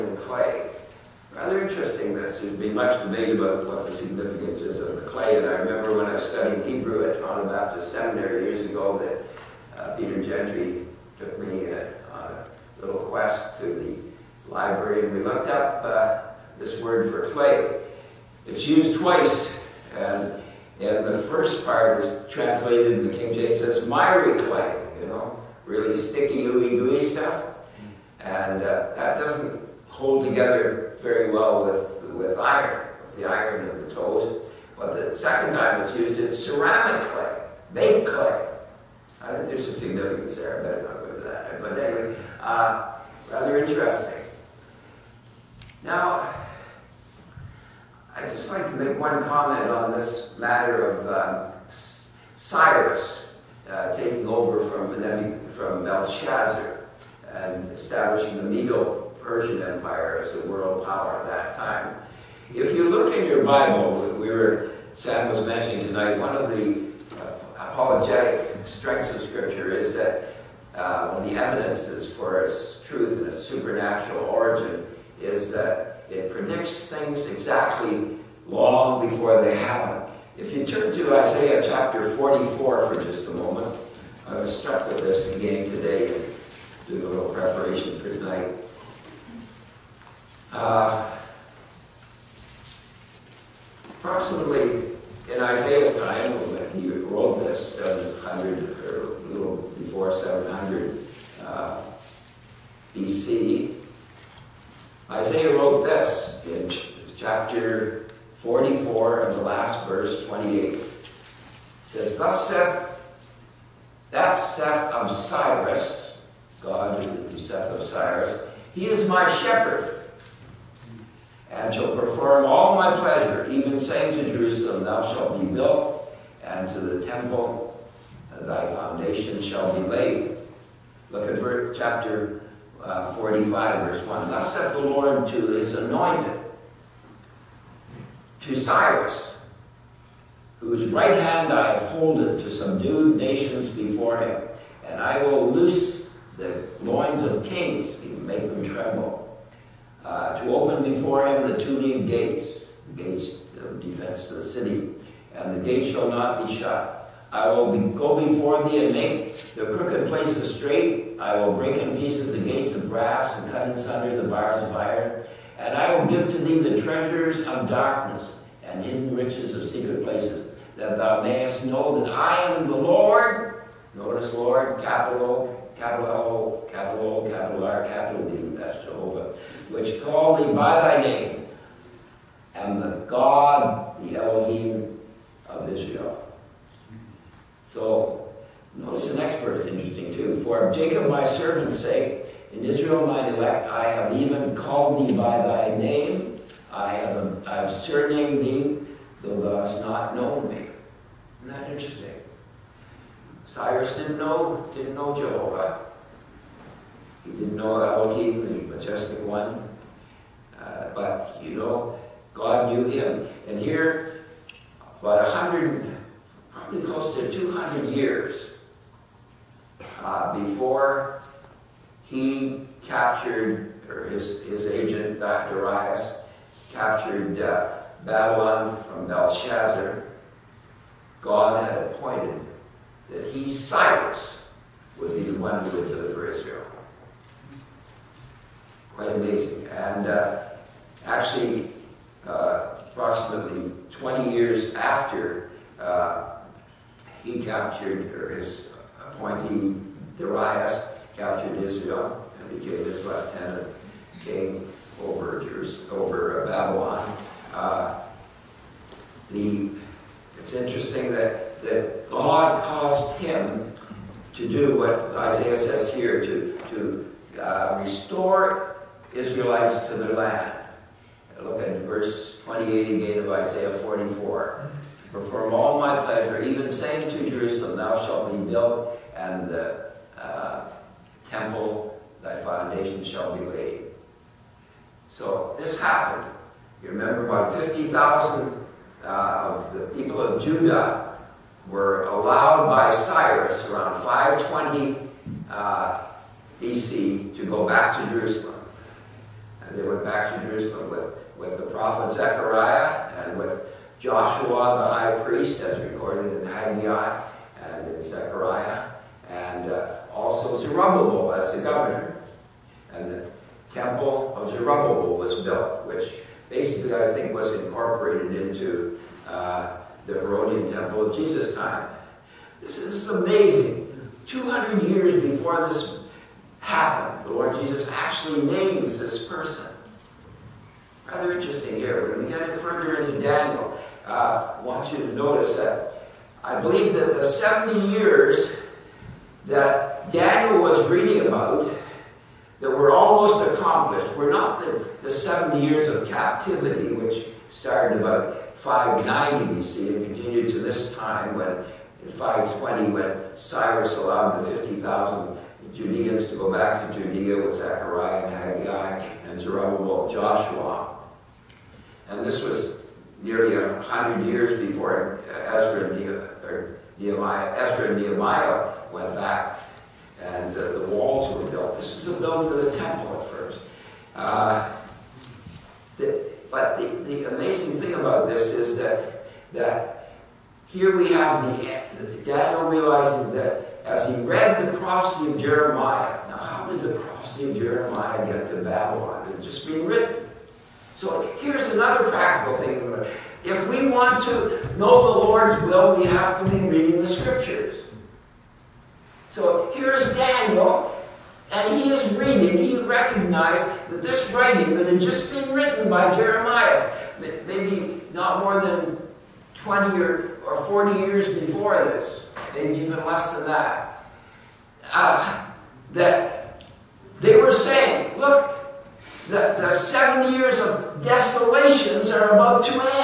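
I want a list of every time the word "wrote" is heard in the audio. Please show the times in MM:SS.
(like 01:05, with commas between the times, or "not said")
01:36, 01:45.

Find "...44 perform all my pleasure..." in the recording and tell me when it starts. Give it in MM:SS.
04:33.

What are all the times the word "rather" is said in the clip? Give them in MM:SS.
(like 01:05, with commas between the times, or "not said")
00:01, 00:43, 05:31.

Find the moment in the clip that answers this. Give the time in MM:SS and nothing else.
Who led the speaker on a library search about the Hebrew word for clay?
00:09.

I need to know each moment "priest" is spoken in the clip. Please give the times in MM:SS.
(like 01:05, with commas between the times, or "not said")
05:05.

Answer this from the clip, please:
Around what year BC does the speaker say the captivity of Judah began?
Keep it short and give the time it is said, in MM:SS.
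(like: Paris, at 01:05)
590 BC, at 05:48.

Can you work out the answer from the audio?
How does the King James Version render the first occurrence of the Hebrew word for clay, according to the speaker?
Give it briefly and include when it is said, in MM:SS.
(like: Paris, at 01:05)
miry clay, at 00:23.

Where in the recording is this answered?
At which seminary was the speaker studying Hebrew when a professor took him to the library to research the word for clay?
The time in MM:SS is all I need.
00:07.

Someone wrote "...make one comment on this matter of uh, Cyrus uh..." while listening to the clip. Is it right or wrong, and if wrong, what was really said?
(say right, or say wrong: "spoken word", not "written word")
right.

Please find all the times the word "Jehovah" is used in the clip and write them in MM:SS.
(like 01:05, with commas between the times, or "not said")
02:58, 03:25.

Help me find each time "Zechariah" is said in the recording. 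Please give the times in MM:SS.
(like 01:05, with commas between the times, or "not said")
05:02, 05:08, 05:57.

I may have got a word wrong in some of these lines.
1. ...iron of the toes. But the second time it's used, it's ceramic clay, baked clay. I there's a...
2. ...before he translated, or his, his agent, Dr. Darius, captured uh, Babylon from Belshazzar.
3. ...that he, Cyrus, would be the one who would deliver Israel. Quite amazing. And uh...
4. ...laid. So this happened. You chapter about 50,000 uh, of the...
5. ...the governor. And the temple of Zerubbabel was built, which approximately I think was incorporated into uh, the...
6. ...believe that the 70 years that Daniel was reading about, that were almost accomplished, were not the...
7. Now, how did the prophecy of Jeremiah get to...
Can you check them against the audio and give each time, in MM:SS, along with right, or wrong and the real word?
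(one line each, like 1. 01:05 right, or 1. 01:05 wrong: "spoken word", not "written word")
1. 00:33 right
2. 03:40 wrong: "captured", not "translated"
3. 03:53 right
4. 04:43 wrong: "remember", not "chapter"
5. 05:11 wrong: "basically", not "approximately"
6. 05:36 right
7. 06:26 right.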